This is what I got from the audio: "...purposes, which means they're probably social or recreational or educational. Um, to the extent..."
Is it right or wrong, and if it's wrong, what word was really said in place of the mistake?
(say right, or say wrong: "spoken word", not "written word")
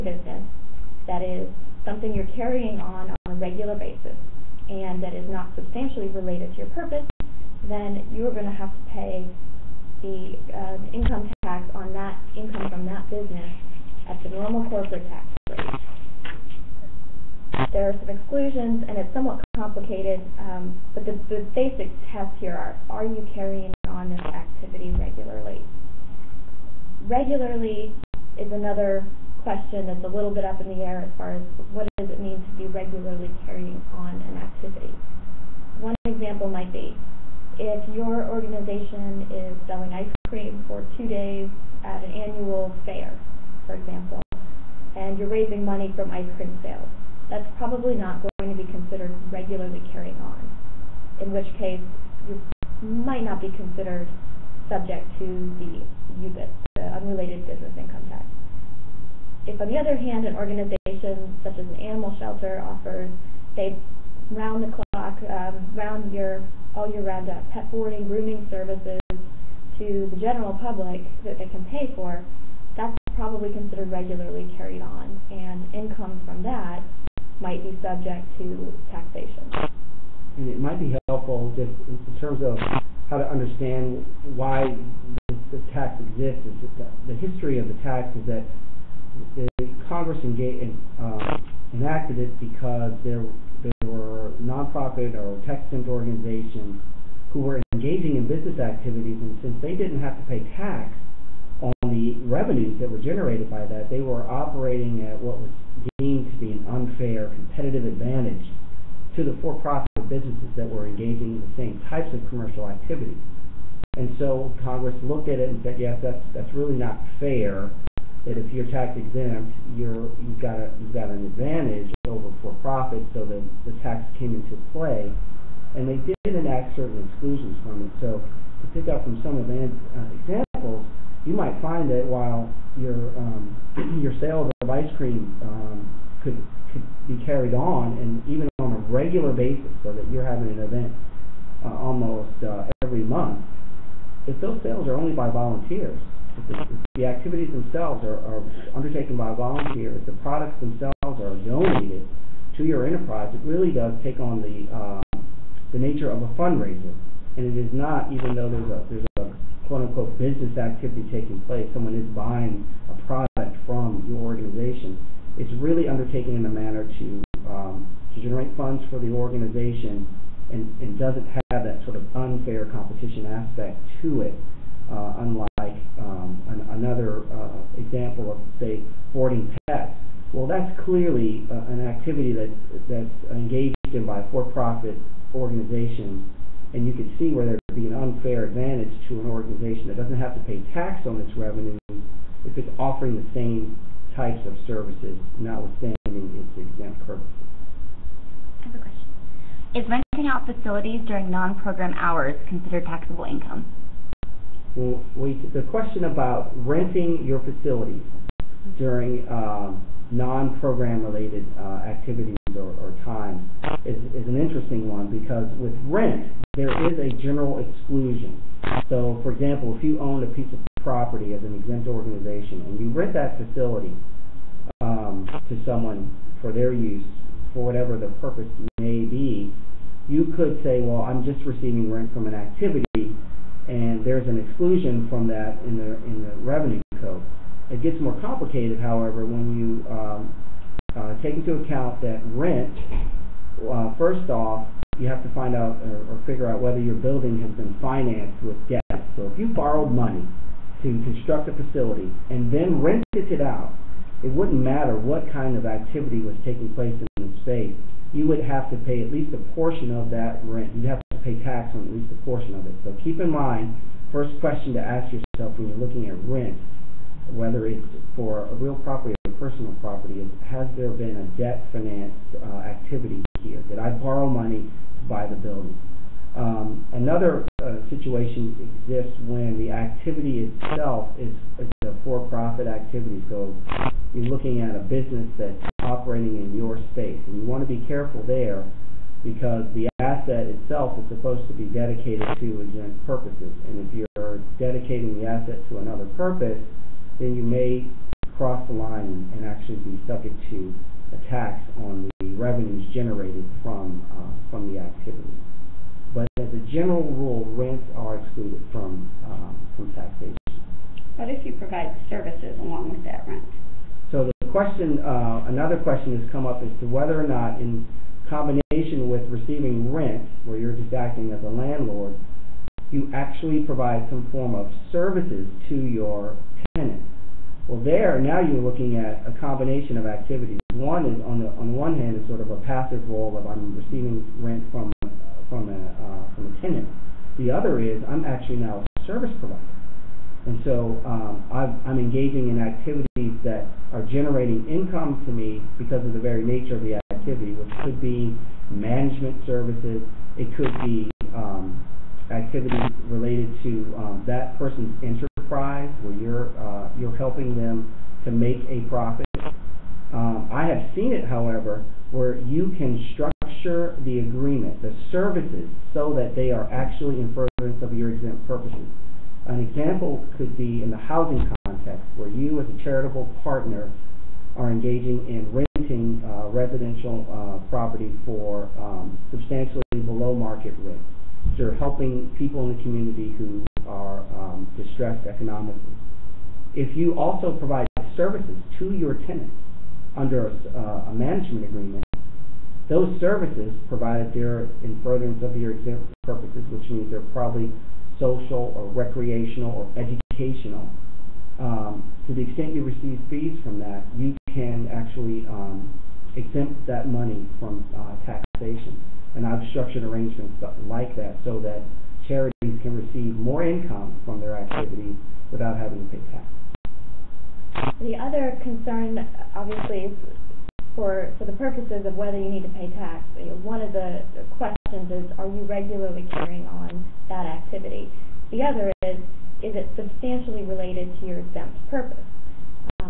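right.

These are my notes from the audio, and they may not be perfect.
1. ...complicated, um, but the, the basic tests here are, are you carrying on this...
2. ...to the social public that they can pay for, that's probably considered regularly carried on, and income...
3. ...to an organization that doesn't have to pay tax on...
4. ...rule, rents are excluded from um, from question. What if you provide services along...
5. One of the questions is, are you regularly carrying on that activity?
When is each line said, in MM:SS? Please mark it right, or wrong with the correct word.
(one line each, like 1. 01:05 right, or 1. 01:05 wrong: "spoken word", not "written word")
1. 00:19 right
2. 01:09 wrong: "general", not "social"
3. 03:09 right
4. 05:07 wrong: "taxation", not "question"
5. 07:03 right.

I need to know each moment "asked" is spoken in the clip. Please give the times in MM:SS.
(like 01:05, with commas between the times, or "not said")
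not said.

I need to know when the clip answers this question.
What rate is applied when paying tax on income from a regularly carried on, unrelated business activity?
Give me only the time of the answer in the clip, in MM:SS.
00:14.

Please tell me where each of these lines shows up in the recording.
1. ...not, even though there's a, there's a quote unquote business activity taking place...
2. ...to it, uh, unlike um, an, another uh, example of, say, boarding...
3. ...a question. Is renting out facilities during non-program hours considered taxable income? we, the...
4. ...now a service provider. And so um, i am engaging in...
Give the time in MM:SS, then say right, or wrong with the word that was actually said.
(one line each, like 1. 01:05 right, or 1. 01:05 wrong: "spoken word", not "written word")
1. 02:37 right
2. 02:54 right
3. 03:18 right
4. 05:38 right.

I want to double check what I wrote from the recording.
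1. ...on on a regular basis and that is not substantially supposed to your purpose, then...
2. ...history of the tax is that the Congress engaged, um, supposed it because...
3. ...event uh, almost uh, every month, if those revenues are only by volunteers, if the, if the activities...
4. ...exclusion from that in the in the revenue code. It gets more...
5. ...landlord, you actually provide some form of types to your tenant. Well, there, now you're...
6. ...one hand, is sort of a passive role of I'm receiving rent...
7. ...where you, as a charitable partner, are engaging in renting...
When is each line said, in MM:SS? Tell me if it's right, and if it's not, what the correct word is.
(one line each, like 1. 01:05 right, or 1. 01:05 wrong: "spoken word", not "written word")
1. 00:02 wrong: "related", not "supposed"
2. 01:27 wrong: "enacted", not "supposed"
3. 02:20 wrong: "sales", not "revenues"
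4. 03:54 right
5. 05:21 wrong: "services", not "types"
6. 05:31 right
7. 06:12 right.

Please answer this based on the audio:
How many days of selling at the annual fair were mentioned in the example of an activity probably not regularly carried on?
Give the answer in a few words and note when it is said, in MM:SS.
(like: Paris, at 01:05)
2, at 00:40.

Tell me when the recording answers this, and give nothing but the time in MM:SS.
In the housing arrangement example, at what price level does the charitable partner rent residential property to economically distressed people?
06:19.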